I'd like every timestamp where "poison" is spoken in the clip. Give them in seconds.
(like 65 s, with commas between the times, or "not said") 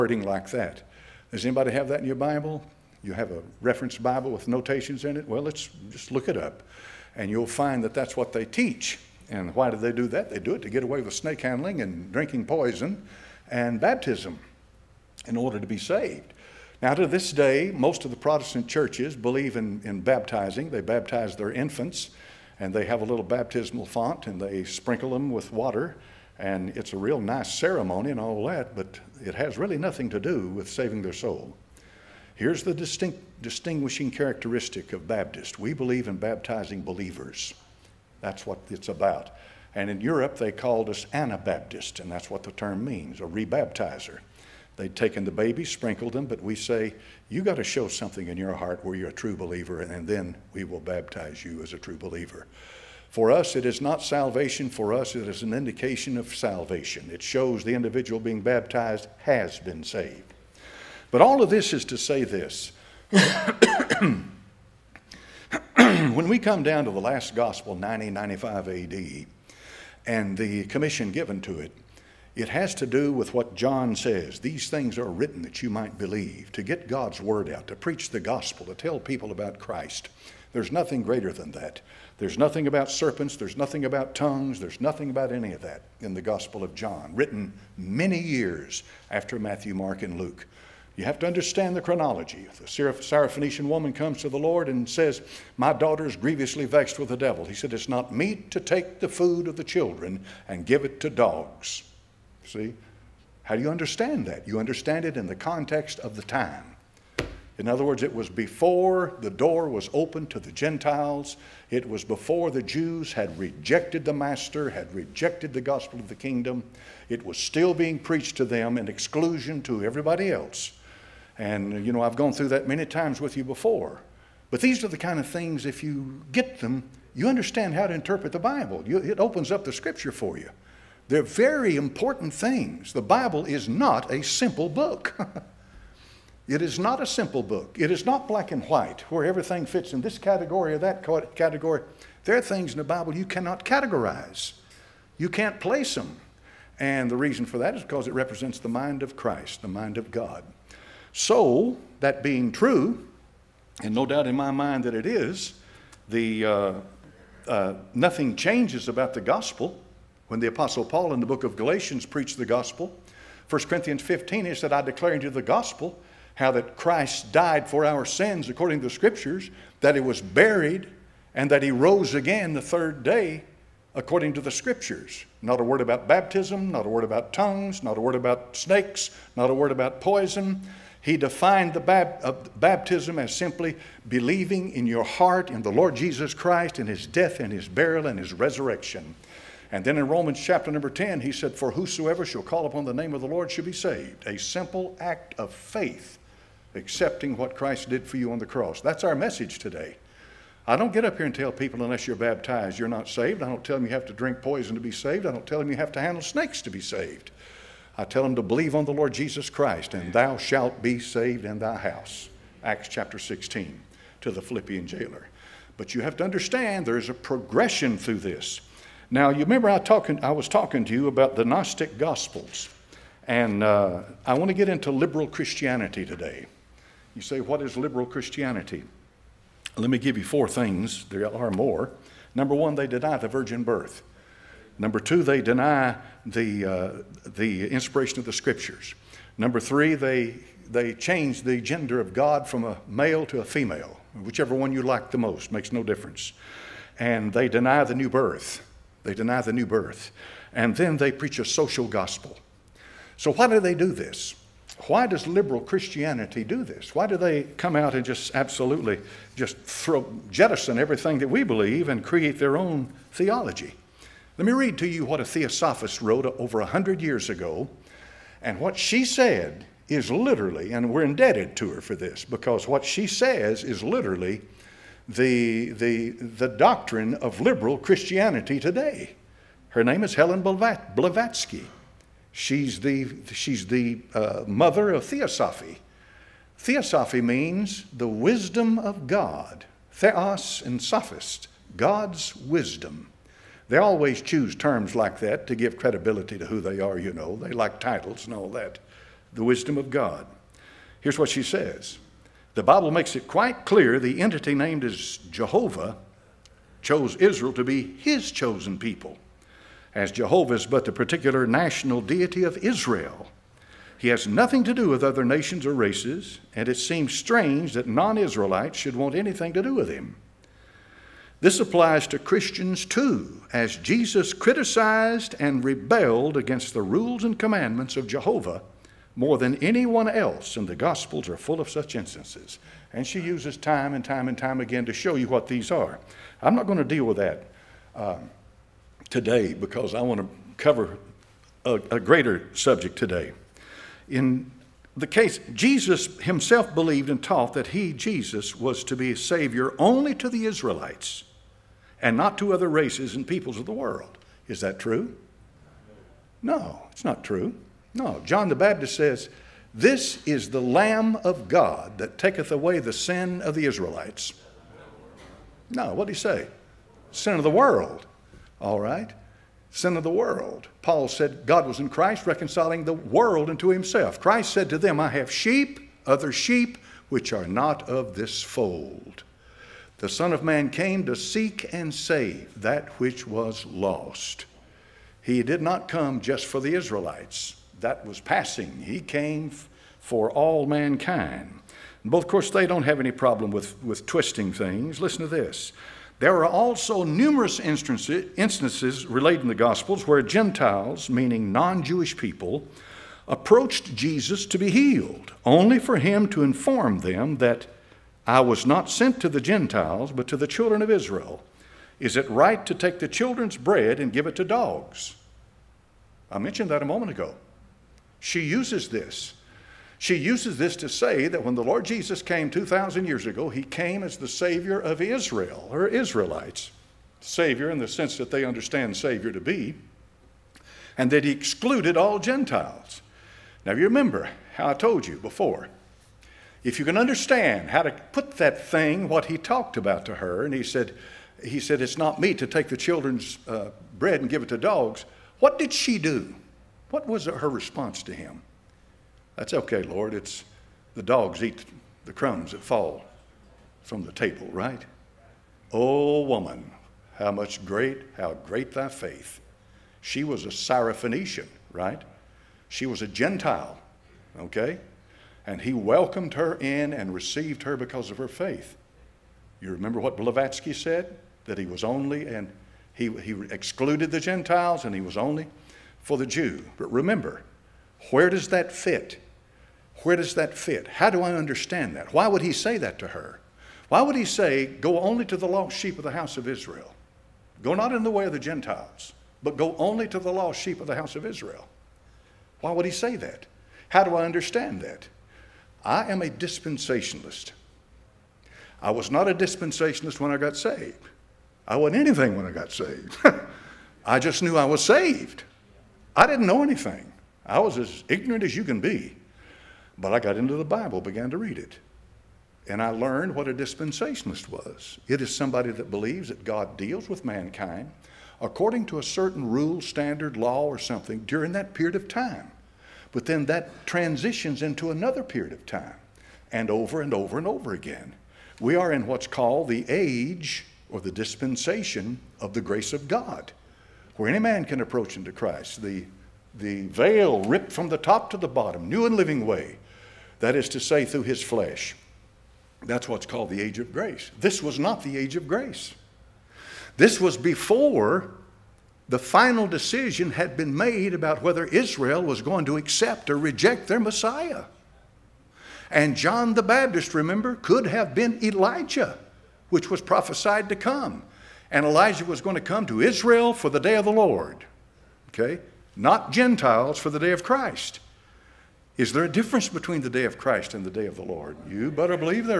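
12 s, 179 s, 204 s.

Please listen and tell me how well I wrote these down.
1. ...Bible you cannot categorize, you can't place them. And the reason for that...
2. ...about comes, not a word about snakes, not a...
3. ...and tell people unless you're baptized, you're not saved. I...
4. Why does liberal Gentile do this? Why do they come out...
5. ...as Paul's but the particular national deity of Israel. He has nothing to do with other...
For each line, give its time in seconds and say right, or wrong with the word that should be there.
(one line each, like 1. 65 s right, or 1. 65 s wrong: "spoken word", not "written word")
1. 142 s right
2. 177 s wrong: "tongues", not "comes"
3. 201 s right
4. 254 s wrong: "Christianity", not "Gentile"
5. 309 s wrong: "Jehovah", not "Paul".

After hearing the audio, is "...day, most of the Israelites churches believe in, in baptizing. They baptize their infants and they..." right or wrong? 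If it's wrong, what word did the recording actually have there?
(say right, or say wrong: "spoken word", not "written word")
wrong: "Protestant", not "Israelites".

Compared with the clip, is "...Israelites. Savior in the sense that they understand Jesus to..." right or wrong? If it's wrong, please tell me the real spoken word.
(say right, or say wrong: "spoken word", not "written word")
wrong: "Savior", not "Jesus".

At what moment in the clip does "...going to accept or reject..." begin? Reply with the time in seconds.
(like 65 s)
552 s.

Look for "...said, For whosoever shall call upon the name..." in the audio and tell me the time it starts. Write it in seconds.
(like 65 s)
191 s.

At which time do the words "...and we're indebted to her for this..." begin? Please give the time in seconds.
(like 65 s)
270 s.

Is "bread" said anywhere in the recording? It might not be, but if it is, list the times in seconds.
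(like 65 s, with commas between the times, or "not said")
413 s, 443 s.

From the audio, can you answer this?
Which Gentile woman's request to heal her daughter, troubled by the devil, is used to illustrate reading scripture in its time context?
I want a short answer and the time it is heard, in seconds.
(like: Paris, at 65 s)
Syrophoenician woman, at 92 s.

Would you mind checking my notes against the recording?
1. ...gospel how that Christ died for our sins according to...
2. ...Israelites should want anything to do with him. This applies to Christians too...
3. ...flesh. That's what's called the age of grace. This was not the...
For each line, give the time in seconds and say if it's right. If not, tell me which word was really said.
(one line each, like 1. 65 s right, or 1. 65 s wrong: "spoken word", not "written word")
1. 165 s right
2. 318 s right
3. 541 s right.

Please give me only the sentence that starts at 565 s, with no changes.
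Not Gentiles for the day of Christ.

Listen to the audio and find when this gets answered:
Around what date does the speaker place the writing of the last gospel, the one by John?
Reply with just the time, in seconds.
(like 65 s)
67 s.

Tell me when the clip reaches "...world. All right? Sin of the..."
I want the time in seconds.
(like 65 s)
367 s.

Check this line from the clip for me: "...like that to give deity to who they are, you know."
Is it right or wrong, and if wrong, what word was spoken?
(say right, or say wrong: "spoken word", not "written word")
wrong: "credibility", not "deity".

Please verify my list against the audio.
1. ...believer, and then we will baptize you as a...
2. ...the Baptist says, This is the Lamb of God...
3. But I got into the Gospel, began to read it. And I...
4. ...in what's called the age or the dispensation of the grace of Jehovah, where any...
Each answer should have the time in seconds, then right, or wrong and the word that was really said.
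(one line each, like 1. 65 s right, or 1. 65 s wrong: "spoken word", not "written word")
1. 49 s right
2. 358 s right
3. 509 s wrong: "Bible", not "Gospel"
4. 528 s wrong: "God", not "Jehovah".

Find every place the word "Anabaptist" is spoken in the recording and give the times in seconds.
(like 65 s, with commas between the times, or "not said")
41 s.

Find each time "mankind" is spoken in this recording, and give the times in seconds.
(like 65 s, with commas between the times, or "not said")
390 s, 517 s.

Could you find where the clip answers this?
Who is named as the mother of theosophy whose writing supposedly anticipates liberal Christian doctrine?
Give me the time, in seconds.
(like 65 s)
280 s.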